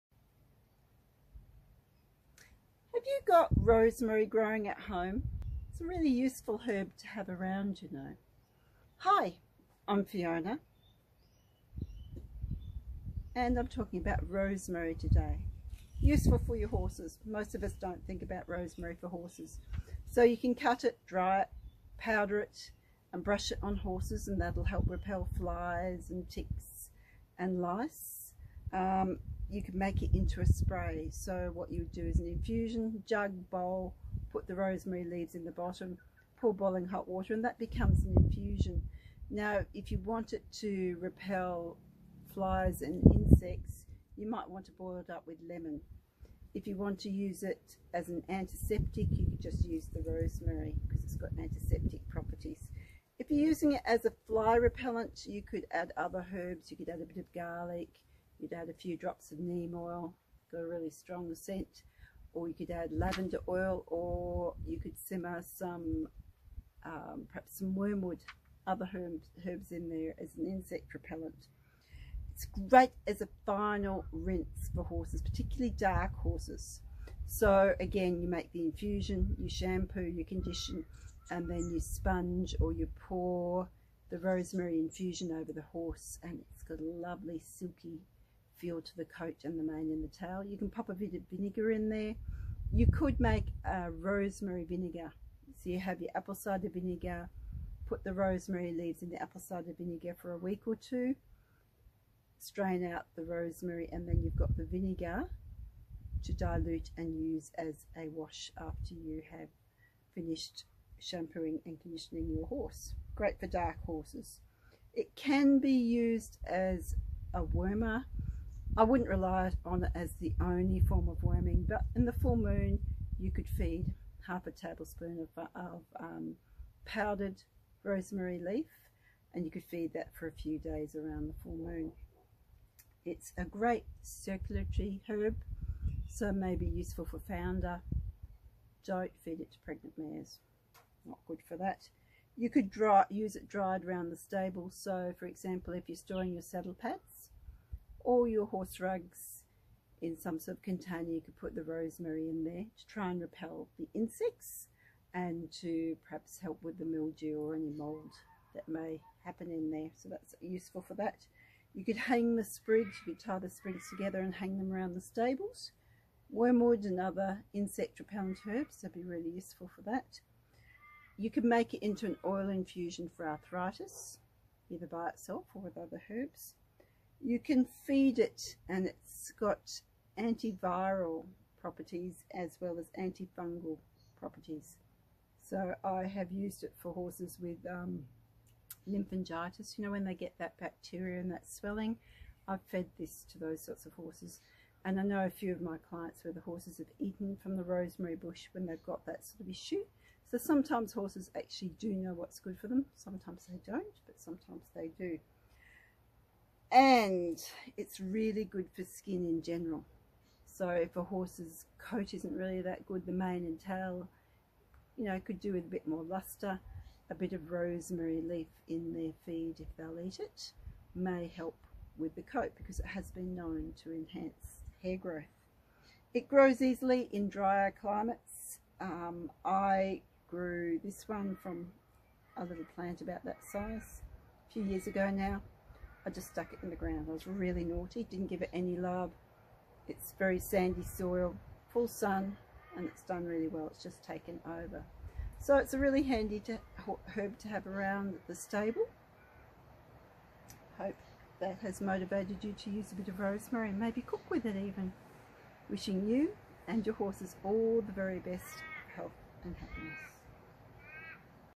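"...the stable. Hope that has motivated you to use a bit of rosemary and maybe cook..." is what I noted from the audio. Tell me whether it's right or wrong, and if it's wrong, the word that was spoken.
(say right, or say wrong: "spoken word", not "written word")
right.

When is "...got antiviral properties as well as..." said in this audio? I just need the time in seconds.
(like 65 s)
179 s.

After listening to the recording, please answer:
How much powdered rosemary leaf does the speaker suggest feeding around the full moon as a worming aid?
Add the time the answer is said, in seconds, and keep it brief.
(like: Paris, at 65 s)
half a tablespoon, at 124 s.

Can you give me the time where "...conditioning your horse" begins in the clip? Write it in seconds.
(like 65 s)
111 s.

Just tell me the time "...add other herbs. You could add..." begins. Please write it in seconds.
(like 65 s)
55 s.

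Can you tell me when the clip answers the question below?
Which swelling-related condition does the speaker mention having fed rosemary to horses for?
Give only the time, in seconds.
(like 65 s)
188 s.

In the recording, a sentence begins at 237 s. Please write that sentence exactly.
I was really naughty, didn't give it any love.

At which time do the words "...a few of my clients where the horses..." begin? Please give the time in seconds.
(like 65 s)
195 s.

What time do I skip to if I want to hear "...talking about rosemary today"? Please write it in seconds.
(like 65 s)
13 s.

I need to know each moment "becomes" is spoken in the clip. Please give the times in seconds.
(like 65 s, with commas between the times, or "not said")
37 s.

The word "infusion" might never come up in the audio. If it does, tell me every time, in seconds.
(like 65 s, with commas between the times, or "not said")
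32 s, 38 s, 78 s, 84 s, 172 s.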